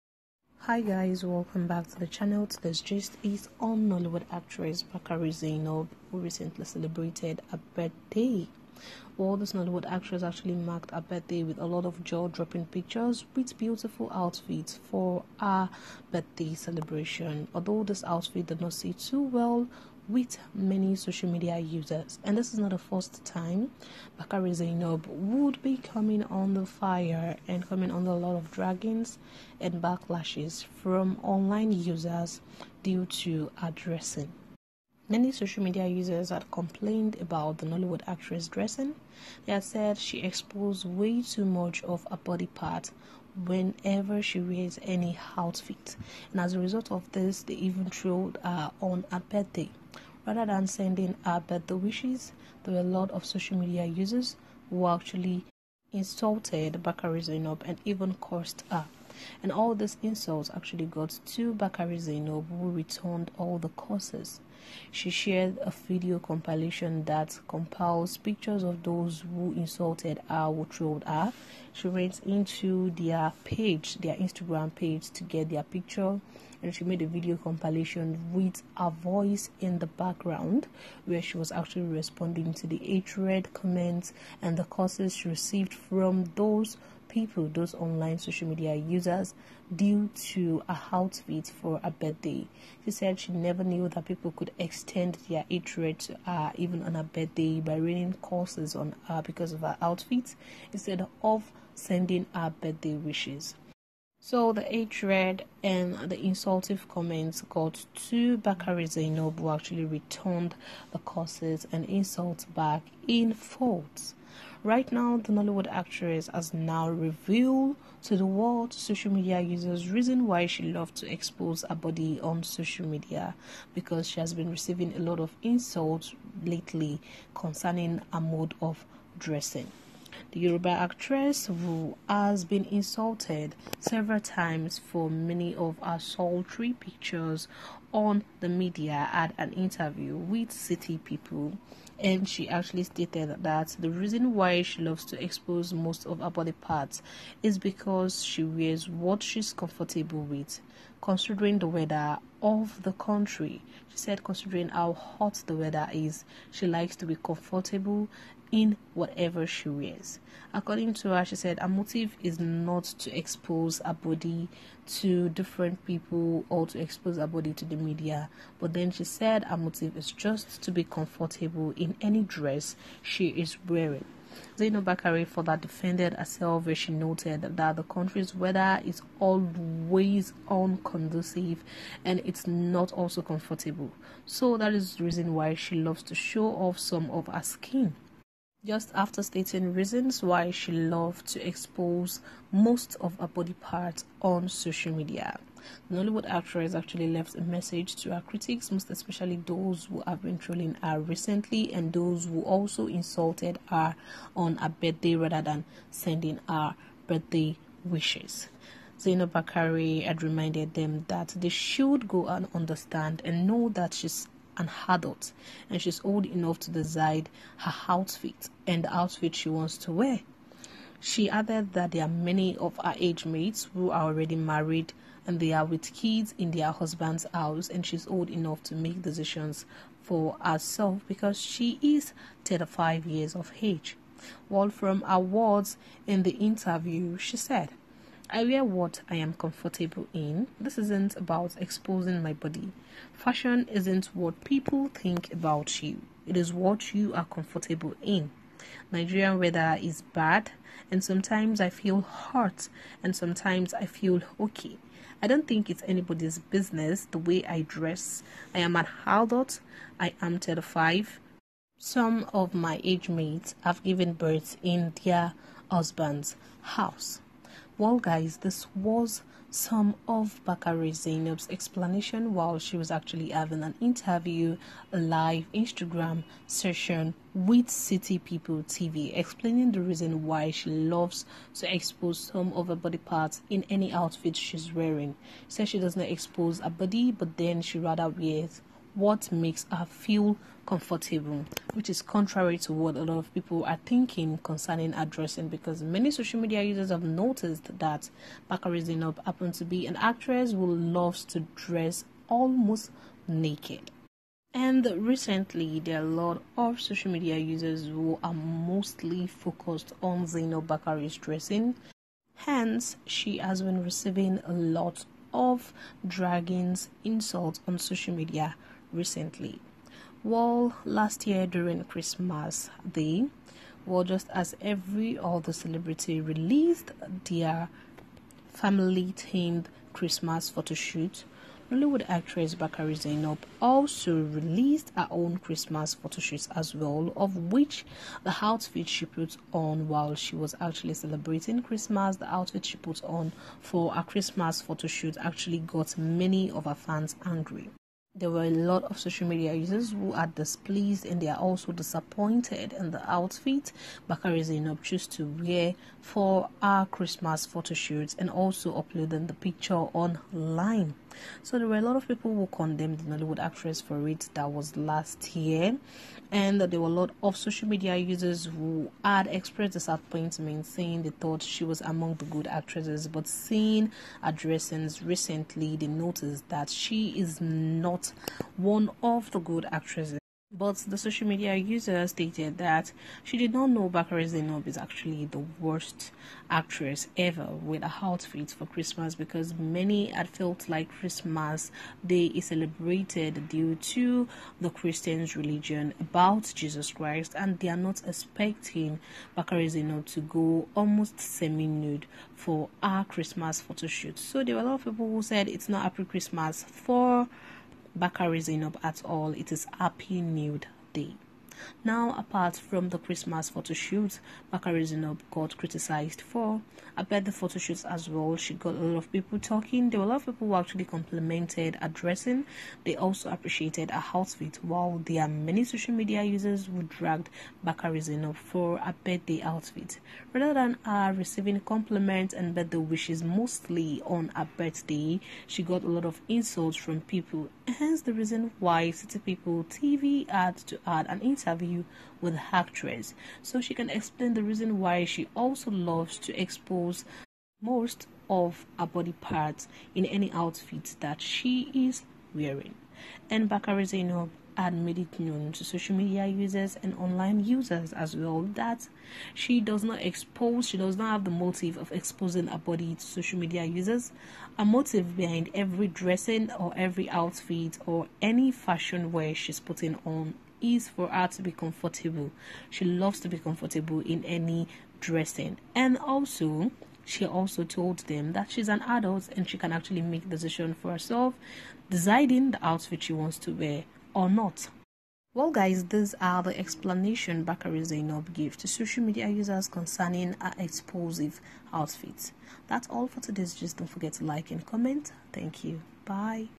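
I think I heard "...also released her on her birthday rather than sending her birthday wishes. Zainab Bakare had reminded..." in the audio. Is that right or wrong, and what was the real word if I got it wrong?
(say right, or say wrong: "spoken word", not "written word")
wrong: "insulted", not "released".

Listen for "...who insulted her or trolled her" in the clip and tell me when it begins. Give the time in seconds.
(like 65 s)
69 s.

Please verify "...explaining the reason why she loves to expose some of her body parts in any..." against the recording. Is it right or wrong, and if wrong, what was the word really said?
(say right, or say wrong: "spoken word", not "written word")
right.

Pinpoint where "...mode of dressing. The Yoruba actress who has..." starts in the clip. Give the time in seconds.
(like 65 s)
128 s.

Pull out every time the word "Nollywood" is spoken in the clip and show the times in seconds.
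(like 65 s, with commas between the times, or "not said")
3 s, 9 s, 37 s, 115 s, 195 s, 331 s, 363 s.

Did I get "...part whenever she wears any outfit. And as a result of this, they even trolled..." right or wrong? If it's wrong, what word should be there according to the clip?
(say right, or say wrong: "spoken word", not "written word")
right.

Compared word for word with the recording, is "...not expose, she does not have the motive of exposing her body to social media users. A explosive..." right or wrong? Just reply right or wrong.
wrong.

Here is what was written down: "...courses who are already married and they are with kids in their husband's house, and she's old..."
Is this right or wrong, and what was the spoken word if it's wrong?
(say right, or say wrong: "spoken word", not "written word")
wrong: "mates", not "courses".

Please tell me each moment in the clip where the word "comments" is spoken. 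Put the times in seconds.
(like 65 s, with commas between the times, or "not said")
83 s, 106 s, 494 s.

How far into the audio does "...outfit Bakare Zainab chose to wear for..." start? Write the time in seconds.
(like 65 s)
353 s.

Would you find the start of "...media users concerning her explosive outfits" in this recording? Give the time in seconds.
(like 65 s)
489 s.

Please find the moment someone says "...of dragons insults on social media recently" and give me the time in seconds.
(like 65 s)
315 s.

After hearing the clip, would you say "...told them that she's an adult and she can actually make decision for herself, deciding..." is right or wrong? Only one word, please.
right.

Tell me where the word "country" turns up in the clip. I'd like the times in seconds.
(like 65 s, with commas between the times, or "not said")
152 s, 177 s.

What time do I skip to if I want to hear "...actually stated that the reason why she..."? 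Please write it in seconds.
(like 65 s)
142 s.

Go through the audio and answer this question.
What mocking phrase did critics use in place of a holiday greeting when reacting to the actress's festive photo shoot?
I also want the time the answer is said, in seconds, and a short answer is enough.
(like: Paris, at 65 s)
Happy Nude Day, at 409 s.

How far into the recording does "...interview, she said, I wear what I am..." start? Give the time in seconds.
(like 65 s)
236 s.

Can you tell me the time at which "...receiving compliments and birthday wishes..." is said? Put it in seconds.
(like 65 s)
431 s.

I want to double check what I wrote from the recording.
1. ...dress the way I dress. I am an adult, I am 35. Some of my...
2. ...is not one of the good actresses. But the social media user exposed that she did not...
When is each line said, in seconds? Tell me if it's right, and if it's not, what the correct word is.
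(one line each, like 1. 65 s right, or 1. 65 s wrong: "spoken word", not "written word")
1. 256 s wrong: "business", not "dress"
2. 377 s wrong: "stated", not "exposed".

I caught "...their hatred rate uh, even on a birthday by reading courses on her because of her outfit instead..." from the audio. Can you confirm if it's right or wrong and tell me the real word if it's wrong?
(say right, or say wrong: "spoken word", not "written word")
right.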